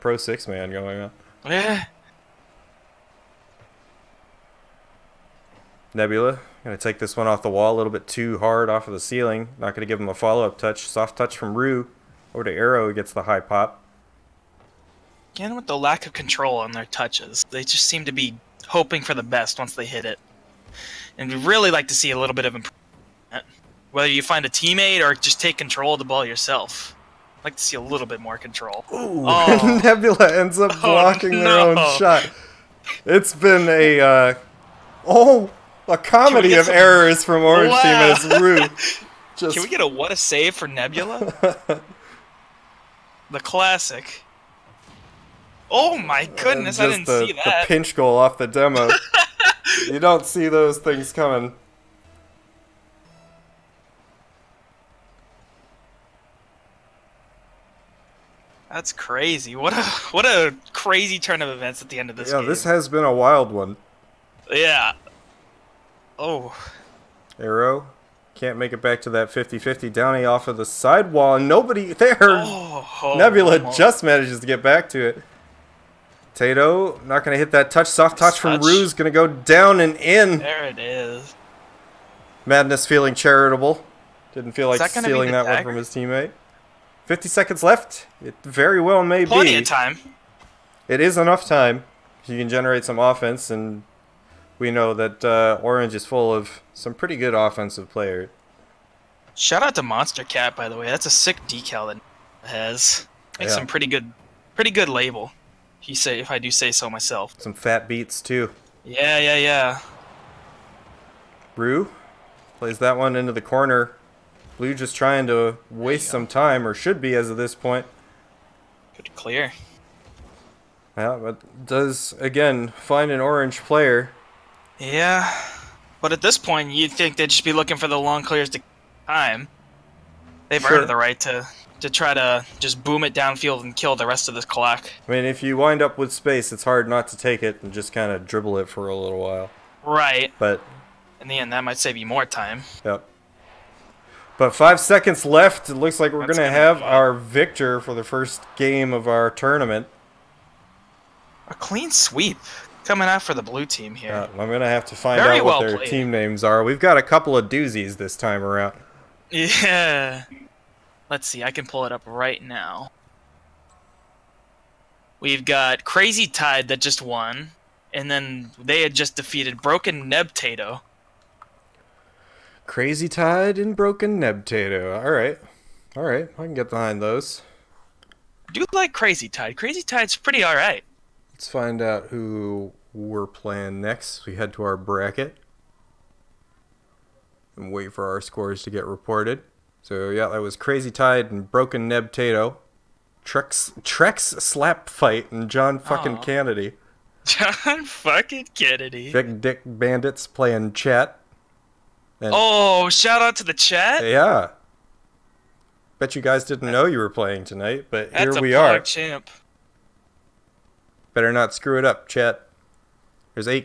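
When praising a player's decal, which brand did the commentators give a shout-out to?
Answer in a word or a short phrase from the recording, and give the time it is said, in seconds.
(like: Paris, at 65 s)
Monstercat, at 99 s.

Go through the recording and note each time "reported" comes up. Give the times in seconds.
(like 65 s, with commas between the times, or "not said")
188 s.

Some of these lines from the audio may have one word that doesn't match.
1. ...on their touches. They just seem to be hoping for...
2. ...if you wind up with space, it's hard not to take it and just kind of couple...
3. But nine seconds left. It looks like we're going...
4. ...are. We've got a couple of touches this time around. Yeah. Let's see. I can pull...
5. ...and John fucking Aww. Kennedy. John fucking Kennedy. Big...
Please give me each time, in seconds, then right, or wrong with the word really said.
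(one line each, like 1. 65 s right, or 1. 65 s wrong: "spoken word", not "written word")
1. 16 s right
2. 135 s wrong: "dribble", not "couple"
3. 144 s wrong: "five", not "nine"
4. 156 s wrong: "doozies", not "touches"
5. 195 s right.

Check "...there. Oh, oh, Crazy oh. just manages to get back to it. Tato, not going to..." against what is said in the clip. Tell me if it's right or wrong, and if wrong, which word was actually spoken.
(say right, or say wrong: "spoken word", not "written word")
wrong: "Nebula", not "Crazy".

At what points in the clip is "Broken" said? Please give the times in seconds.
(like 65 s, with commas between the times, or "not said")
169 s, 173 s, 191 s.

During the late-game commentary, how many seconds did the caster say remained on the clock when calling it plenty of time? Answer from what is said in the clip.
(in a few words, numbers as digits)
50.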